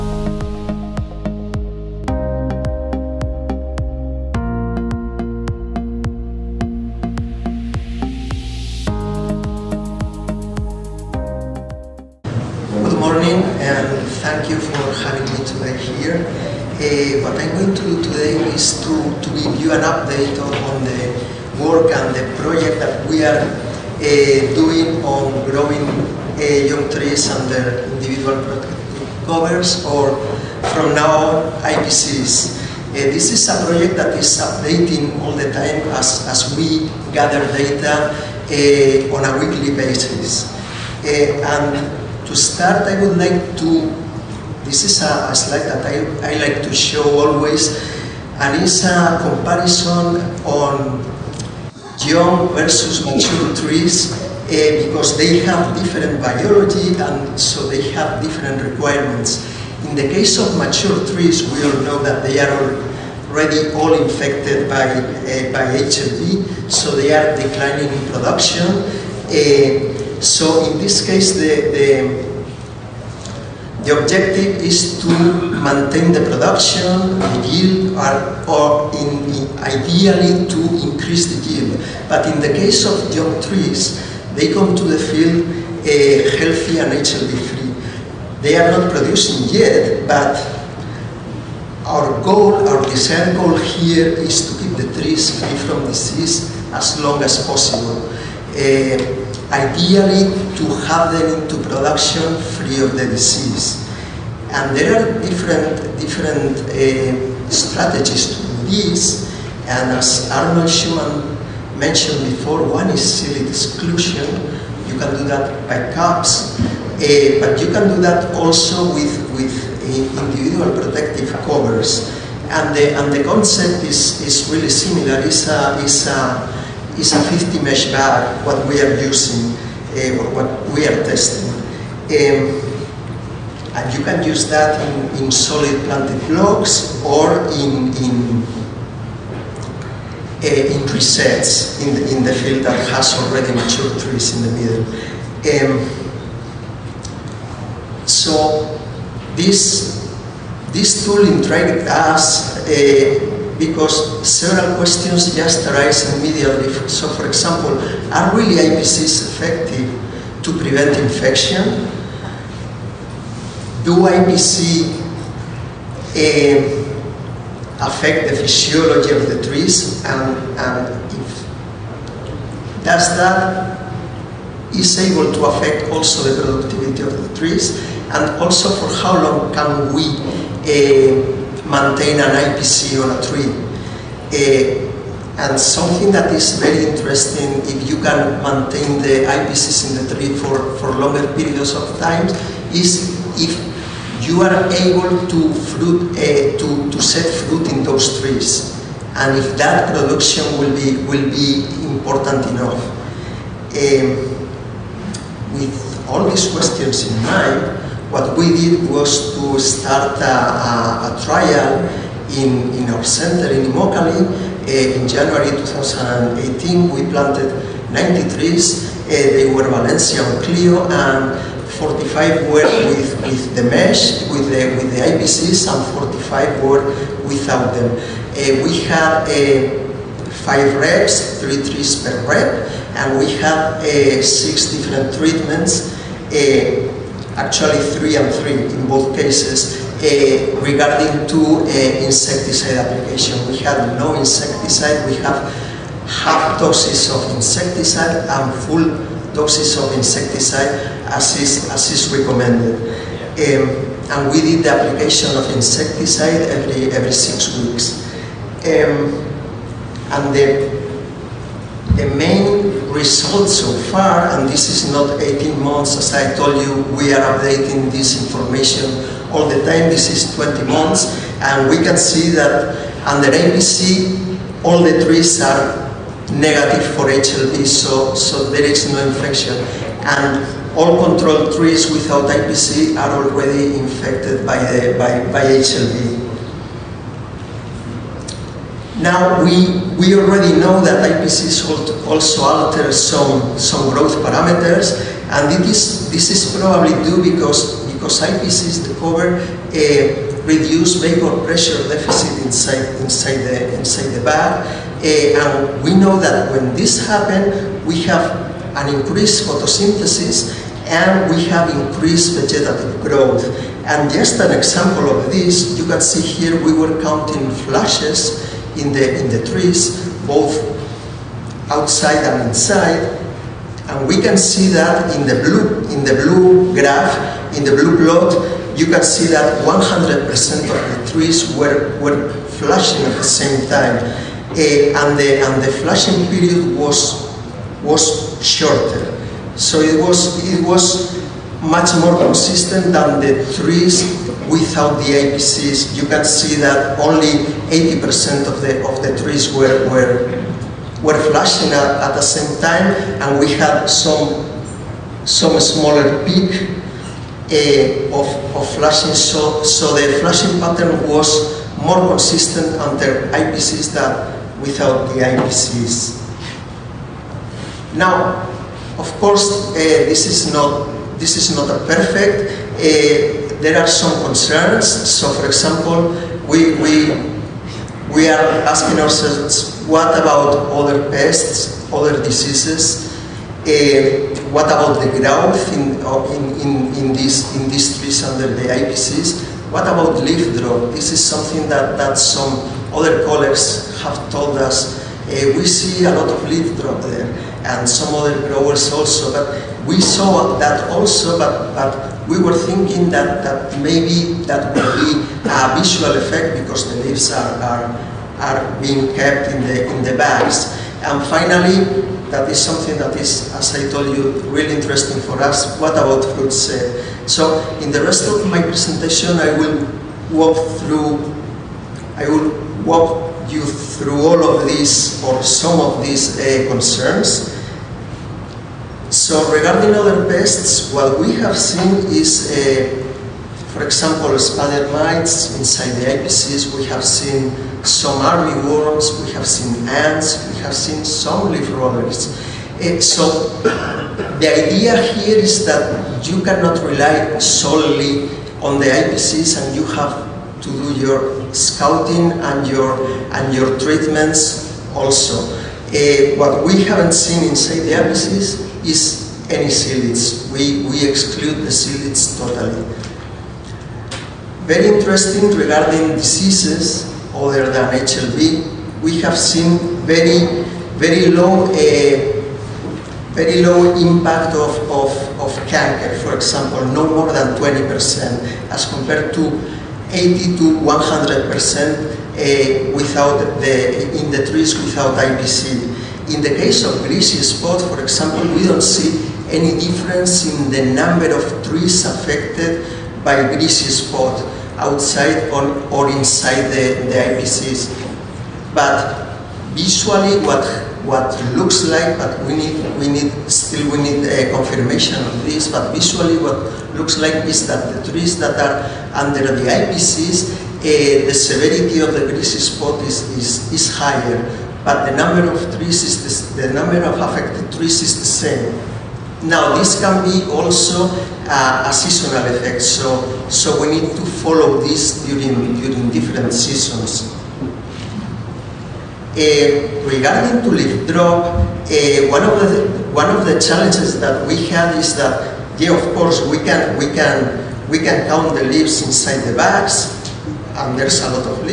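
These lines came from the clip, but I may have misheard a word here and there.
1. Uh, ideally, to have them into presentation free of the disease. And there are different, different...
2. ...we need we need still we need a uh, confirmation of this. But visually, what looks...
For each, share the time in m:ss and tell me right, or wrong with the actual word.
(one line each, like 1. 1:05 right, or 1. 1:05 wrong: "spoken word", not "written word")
1. 1:38 wrong: "production", not "presentation"
2. 8:22 right.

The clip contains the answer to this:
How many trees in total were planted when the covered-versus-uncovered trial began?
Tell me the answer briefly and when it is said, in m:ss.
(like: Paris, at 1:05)
90, at 3:37.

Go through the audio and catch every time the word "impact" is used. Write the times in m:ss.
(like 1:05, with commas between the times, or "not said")
7:53.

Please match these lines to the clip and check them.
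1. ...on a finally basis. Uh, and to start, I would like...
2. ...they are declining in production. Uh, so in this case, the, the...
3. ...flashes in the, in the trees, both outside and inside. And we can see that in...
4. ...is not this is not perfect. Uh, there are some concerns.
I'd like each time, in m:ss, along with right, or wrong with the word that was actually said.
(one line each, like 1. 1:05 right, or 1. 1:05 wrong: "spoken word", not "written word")
1. 0:39 wrong: "weekly", not "finally"
2. 1:06 right
3. 5:17 right
4. 6:10 right.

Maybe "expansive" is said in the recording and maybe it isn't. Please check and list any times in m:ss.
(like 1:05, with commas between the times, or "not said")
not said.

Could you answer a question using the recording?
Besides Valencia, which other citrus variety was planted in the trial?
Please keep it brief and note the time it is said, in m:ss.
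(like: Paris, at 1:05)
Clio, at 3:40.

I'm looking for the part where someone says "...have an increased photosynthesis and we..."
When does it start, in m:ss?
5:08.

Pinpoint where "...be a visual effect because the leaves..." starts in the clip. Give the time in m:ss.
6:44.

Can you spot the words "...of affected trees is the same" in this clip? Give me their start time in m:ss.
8:37.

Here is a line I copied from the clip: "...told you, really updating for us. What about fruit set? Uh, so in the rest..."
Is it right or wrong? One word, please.
wrong.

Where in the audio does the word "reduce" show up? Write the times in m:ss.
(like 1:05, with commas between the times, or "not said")
5:00.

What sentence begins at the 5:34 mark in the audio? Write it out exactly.
Uh, and, the, and the flashing period was, was shorter.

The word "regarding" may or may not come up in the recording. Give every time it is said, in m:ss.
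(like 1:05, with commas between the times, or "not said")
4:00, 7:09, 7:45, 8:50.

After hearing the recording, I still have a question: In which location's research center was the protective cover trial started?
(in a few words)
Immokalee.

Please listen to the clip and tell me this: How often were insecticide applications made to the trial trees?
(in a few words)
every six weeks.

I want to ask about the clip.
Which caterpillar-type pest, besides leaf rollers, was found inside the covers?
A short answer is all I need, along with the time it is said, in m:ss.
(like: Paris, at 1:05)
armyworms, at 7:18.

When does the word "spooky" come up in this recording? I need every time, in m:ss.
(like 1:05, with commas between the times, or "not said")
not said.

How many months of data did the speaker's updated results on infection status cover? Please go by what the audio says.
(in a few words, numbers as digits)
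20 months.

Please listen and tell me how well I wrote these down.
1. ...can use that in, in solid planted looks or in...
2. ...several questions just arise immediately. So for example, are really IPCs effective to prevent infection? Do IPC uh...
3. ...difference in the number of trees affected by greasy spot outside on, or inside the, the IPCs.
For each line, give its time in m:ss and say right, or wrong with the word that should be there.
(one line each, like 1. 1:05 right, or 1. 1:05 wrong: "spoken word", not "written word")
1. 2:14 wrong: "blocks", not "looks"
2. 2:34 right
3. 8:09 right.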